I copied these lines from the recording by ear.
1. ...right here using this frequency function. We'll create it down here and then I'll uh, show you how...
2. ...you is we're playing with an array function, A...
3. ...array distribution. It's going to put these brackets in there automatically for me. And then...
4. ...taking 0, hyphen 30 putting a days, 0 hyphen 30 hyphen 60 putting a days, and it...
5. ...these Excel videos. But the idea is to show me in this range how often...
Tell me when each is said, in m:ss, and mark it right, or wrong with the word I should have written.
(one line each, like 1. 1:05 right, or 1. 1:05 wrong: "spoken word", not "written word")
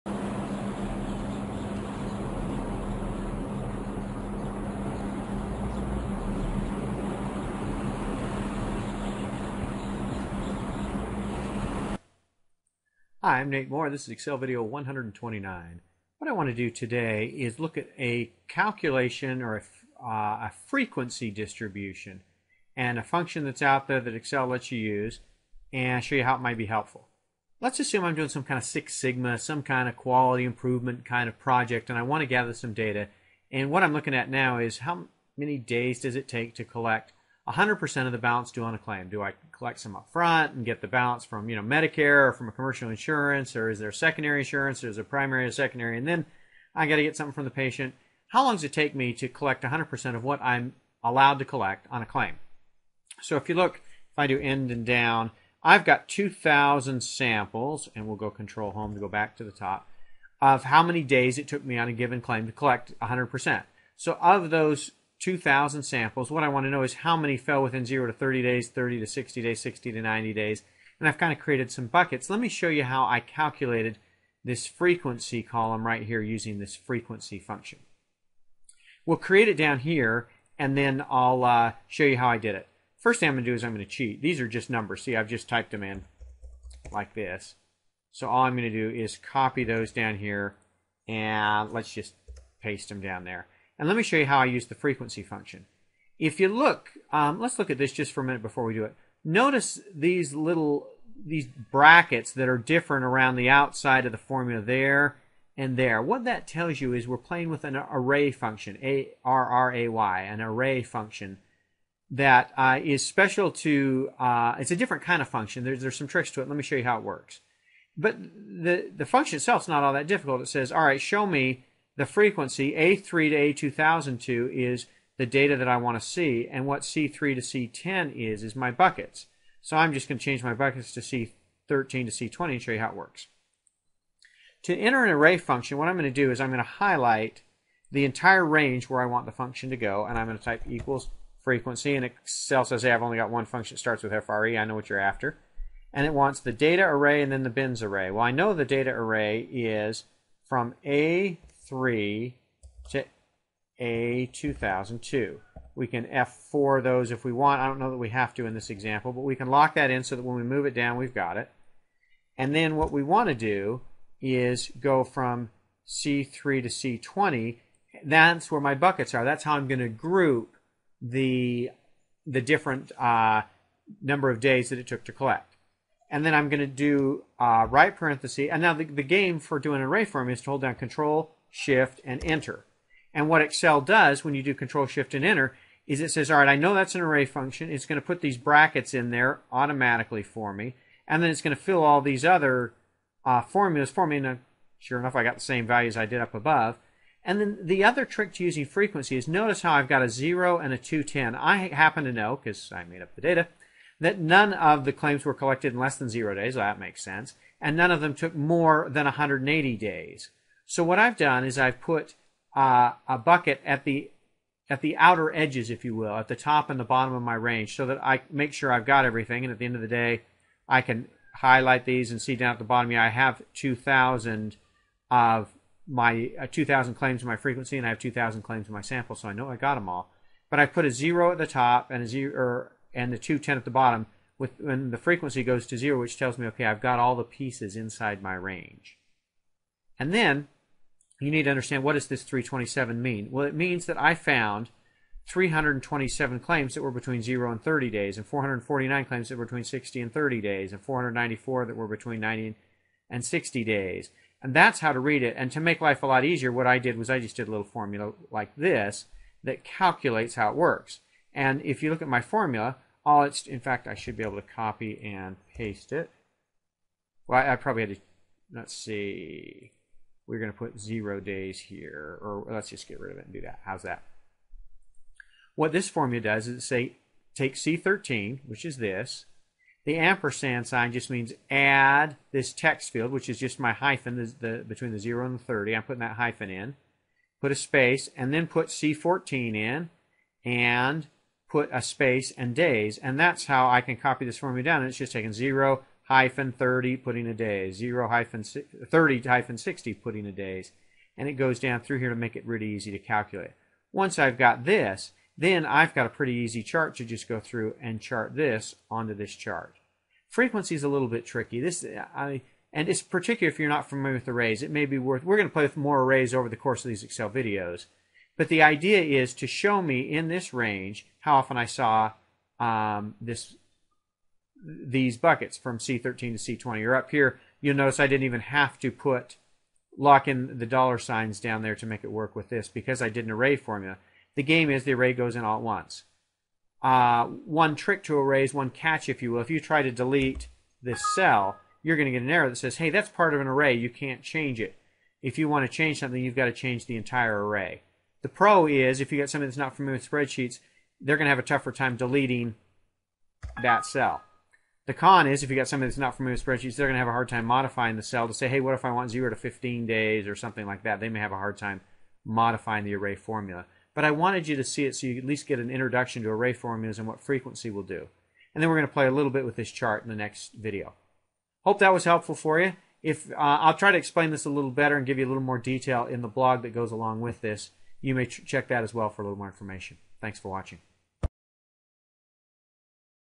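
1. 1:15 right
2. 1:46 right
3. 3:07 wrong: "function", not "distribution"
4. 4:55 right
5. 5:16 right.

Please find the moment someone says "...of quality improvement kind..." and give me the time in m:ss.
0:29.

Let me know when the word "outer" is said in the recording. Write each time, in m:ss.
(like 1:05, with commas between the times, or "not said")
3:34.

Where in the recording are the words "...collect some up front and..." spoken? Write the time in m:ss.
0:39.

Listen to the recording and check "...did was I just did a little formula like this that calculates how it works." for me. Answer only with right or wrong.
right.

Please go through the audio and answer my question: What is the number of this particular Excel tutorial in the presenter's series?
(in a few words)
129.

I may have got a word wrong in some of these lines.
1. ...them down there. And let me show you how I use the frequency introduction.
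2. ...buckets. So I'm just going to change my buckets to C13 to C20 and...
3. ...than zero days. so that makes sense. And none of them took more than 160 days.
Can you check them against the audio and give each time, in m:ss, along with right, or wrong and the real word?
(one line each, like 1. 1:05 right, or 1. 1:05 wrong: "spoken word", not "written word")
1. 1:32 wrong: "function", not "introduction"
2. 2:08 right
3. 3:25 wrong: "180", not "160".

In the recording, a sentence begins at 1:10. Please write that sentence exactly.
And I've kind of created some buckets.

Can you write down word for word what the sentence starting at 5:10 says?
Frequency is a little bit tricky.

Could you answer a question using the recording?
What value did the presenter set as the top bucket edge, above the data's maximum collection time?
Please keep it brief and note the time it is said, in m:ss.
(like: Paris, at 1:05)
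210, at 3:20.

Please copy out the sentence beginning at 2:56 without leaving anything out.
And then I'm going to do uh, right parenthesis.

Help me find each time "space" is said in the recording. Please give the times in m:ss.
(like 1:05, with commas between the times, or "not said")
4:47, 4:51.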